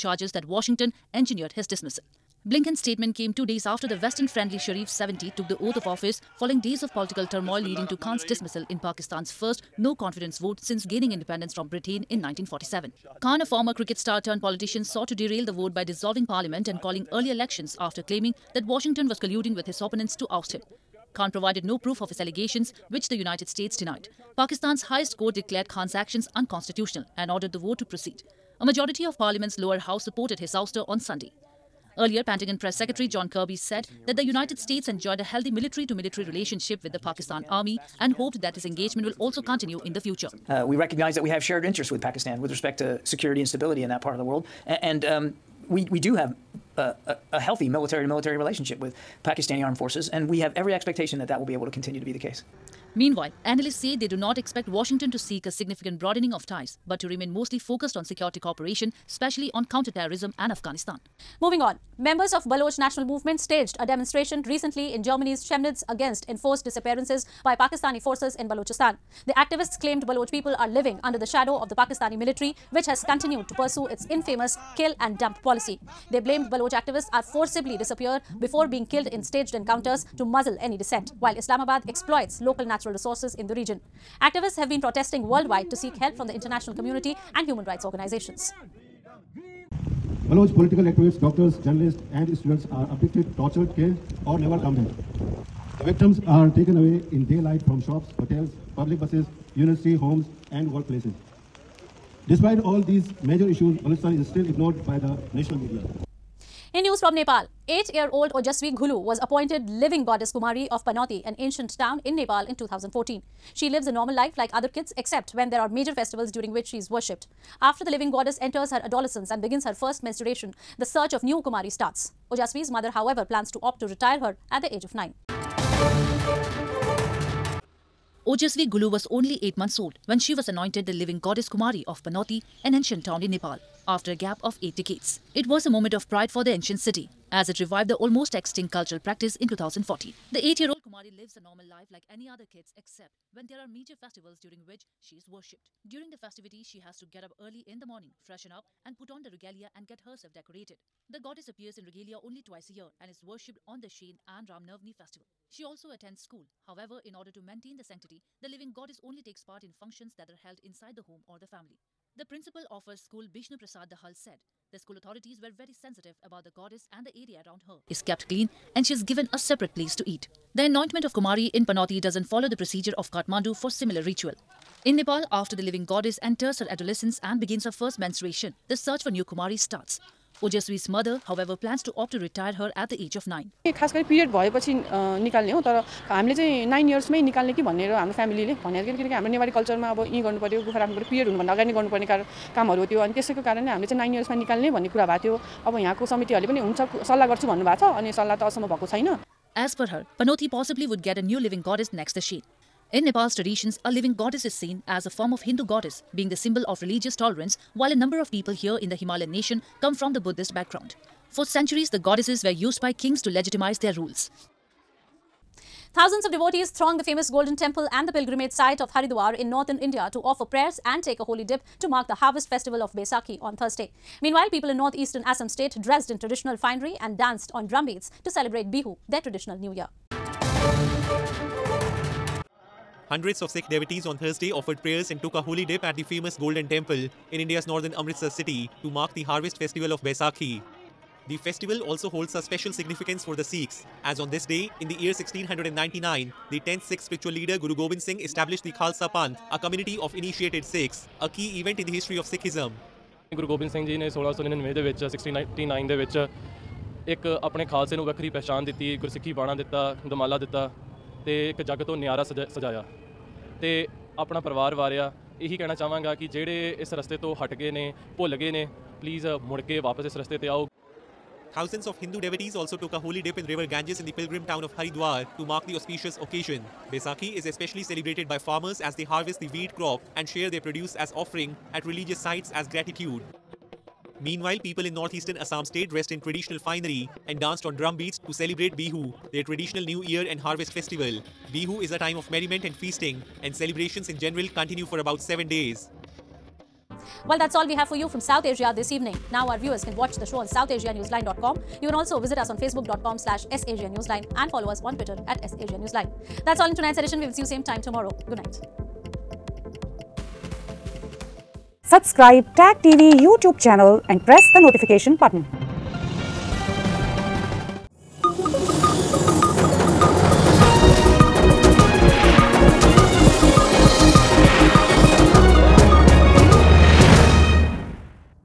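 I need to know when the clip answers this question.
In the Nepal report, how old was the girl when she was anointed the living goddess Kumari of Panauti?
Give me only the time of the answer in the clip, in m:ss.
2:09.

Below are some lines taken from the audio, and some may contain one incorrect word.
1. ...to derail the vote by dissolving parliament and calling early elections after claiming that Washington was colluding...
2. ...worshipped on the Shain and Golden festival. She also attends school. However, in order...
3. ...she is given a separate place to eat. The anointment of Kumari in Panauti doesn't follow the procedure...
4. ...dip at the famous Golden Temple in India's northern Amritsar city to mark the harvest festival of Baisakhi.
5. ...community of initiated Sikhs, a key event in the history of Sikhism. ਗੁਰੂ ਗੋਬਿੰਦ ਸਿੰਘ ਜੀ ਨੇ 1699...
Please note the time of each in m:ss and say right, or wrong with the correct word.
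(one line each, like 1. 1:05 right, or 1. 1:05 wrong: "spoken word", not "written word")
1. 0:15 right
2. 2:33 wrong: "Ramnavmi", not "Golden"
3. 2:48 right
4. 3:55 right
5. 4:09 right.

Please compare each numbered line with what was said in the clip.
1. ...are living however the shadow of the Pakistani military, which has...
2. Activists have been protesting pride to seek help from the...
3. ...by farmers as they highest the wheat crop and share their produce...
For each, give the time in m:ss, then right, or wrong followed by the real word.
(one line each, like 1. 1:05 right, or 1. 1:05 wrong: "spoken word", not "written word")
1. 1:10 wrong: "under", not "however"
2. 1:24 wrong: "worldwide", not "pride"
3. 4:38 wrong: "harvest", not "highest".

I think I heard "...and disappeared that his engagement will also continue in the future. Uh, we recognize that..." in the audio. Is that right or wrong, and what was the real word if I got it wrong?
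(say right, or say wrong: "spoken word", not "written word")
wrong: "hoped", not "disappeared".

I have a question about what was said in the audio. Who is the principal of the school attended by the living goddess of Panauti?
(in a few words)
Bishnu Prasad Dahal.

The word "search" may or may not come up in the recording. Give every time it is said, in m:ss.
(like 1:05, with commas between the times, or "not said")
2:00, 2:58.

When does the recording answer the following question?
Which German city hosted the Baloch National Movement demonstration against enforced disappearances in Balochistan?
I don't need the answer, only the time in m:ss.
1:05.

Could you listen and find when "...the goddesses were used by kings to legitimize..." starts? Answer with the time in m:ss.
3:31.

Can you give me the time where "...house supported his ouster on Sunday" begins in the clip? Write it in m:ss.
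0:29.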